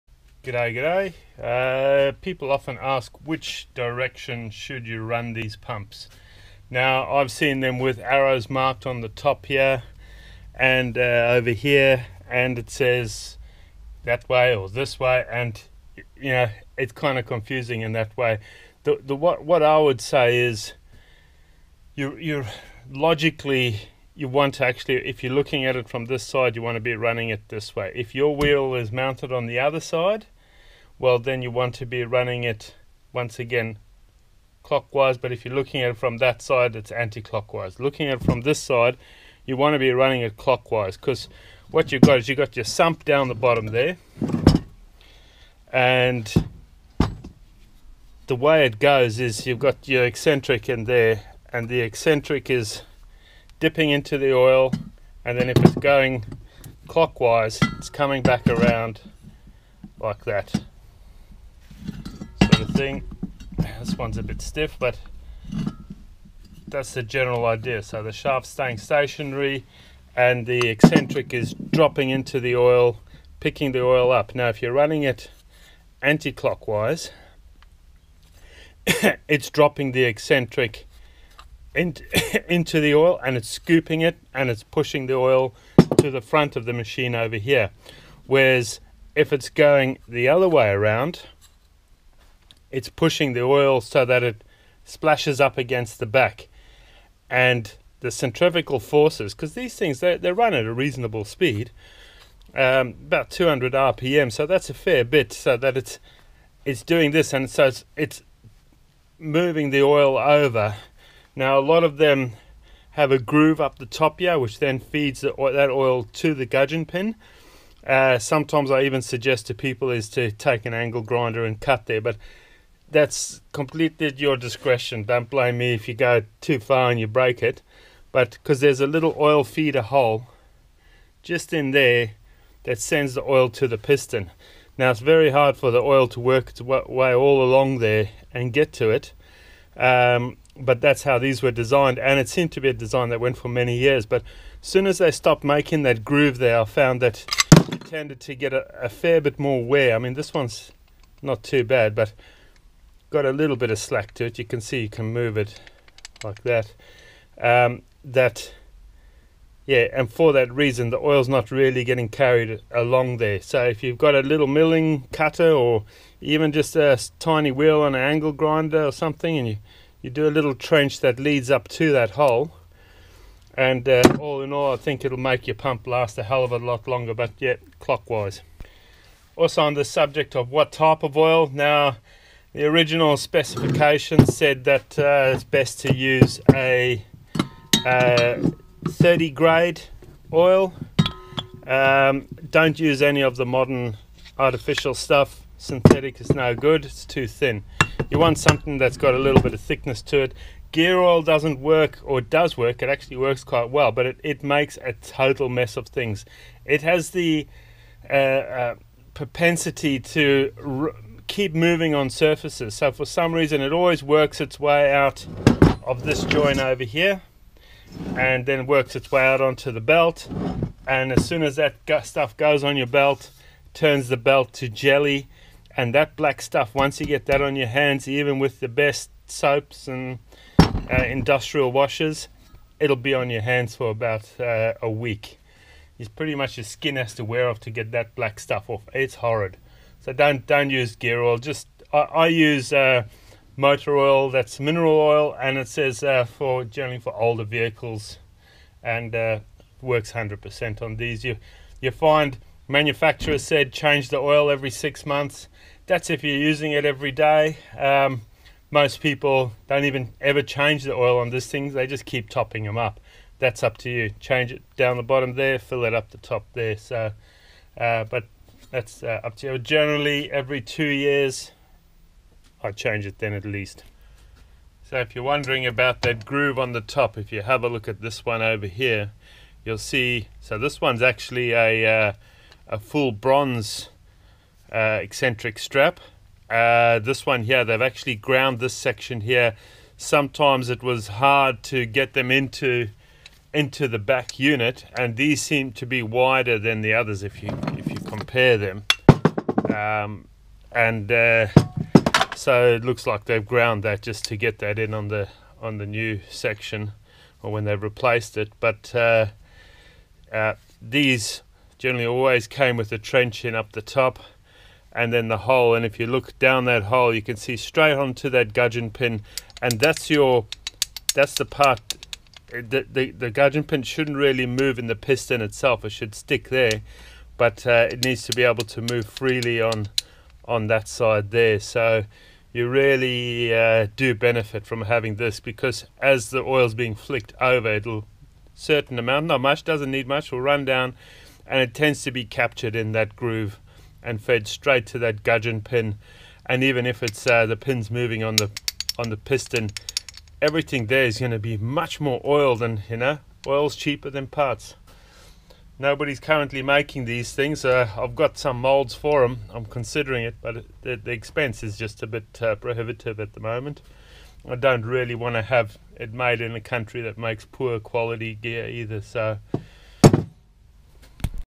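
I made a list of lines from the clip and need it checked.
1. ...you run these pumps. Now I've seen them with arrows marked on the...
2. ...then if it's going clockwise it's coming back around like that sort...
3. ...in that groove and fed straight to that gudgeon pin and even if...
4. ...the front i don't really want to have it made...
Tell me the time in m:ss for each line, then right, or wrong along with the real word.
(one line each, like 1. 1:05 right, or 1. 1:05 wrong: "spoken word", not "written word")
1. 0:04 right
2. 0:55 right
3. 5:42 right
4. 6:03 wrong: "moment", not "front".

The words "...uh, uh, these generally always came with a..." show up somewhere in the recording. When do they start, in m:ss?
5:08.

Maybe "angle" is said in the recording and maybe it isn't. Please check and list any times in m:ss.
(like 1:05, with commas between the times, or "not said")
2:00, 2:48.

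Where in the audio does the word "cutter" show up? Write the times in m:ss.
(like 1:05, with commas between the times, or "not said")
2:45.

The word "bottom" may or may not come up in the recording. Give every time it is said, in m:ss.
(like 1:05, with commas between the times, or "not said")
0:43, 4:25.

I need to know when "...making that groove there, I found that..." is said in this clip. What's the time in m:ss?
2:25.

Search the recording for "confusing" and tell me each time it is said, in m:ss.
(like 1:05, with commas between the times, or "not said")
0:17.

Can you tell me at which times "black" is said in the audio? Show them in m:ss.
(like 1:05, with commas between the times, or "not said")
3:46, 3:58.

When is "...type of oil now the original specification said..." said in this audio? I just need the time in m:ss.
3:00.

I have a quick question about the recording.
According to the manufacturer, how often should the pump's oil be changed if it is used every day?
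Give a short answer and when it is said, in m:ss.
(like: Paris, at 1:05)
Every six months, at 4:14.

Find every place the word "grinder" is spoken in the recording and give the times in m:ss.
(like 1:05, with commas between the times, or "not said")
2:01, 2:48.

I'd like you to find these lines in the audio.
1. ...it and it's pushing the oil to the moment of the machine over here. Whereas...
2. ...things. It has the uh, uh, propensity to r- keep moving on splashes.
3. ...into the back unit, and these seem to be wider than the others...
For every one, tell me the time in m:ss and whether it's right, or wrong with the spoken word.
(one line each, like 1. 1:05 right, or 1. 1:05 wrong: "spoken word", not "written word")
1. 1:24 wrong: "front", not "moment"
2. 3:25 wrong: "surfaces", not "splashes"
3. 4:53 right.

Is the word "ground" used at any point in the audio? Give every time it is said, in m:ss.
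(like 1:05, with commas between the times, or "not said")
4:48, 5:03.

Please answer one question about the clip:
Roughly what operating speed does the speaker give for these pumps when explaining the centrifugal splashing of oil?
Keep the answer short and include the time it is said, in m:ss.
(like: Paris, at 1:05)
200 RPM, at 1:43.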